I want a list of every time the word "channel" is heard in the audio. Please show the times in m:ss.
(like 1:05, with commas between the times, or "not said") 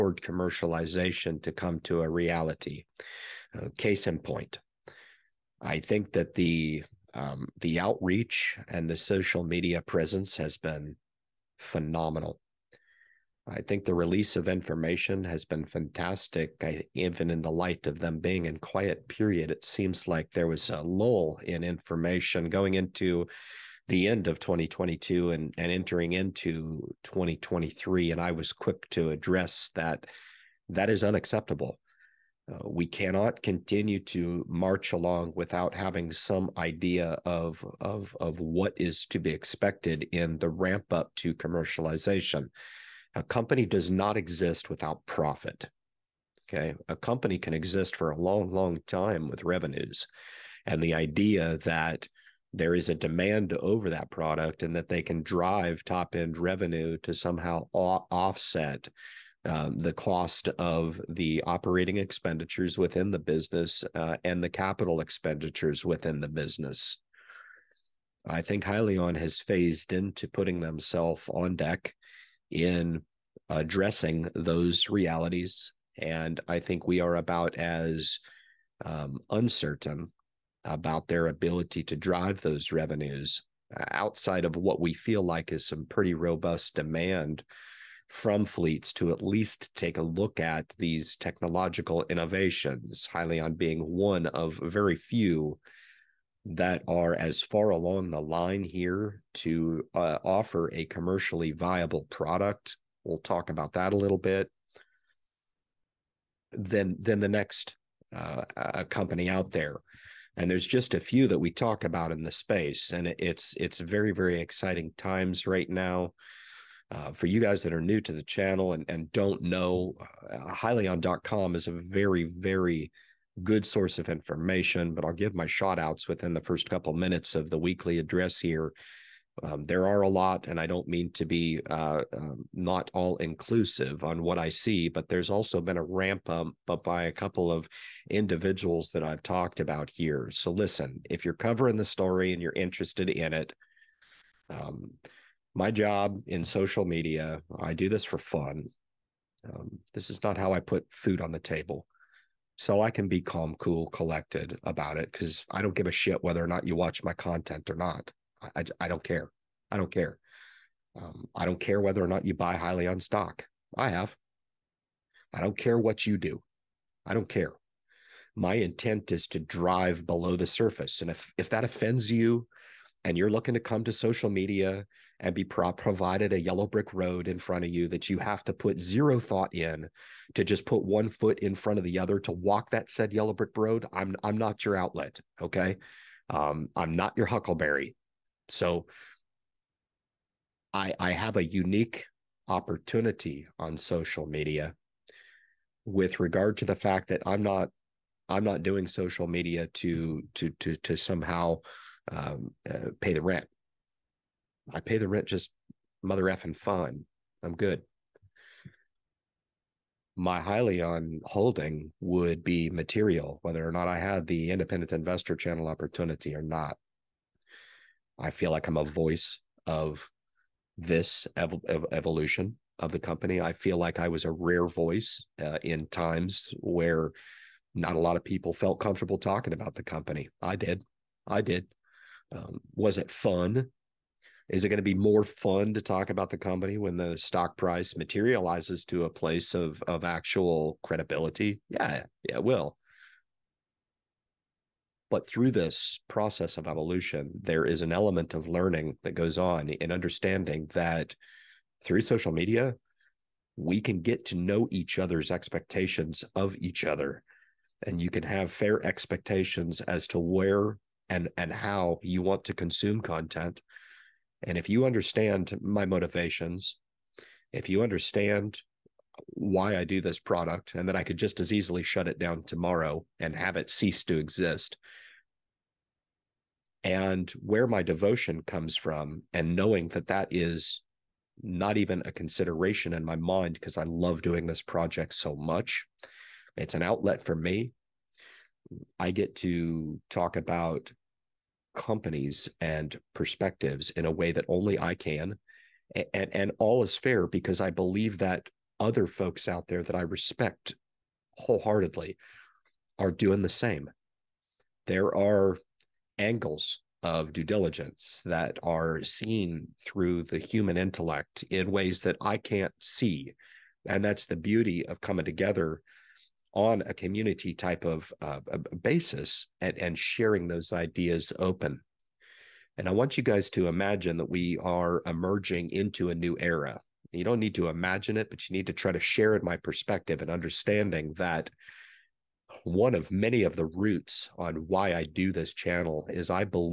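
1:58, 3:35, 5:35.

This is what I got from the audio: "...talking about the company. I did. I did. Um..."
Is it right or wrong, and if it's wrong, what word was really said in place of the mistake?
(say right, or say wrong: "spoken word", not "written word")
right.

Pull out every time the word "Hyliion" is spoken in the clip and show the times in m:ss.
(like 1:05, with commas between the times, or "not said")
1:08, 1:33, 2:42, 3:30.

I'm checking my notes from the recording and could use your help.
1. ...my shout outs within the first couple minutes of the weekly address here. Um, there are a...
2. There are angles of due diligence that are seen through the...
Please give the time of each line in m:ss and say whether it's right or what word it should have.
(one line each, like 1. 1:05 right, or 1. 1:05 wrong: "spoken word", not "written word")
1. 2:05 right
2. 5:04 right.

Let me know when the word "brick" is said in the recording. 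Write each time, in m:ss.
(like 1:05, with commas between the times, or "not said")
2:56, 3:03.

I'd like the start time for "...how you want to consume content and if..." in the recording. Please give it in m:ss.
4:21.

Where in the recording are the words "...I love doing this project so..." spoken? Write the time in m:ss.
4:43.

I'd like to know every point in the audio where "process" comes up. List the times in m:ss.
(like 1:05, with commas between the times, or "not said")
4:06.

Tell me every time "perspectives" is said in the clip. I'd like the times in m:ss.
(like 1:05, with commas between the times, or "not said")
4:53, 5:29.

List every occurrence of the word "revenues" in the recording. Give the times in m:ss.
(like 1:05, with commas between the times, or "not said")
0:49, 0:56, 1:22.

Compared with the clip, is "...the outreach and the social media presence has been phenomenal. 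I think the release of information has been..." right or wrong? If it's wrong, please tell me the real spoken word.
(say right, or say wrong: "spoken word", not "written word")
right.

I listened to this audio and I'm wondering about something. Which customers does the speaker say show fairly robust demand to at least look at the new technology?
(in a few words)
fleets.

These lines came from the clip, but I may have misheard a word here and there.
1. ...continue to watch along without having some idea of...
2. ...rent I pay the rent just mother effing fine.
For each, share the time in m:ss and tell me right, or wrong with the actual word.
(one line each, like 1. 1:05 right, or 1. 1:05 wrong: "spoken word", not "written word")
1. 0:33 wrong: "march", not "watch"
2. 3:23 right.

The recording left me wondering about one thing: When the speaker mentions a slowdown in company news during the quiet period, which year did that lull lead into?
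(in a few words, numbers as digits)
2023.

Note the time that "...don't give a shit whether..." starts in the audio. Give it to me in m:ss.
2:35.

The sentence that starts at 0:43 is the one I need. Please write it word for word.
A company does not exist without profit.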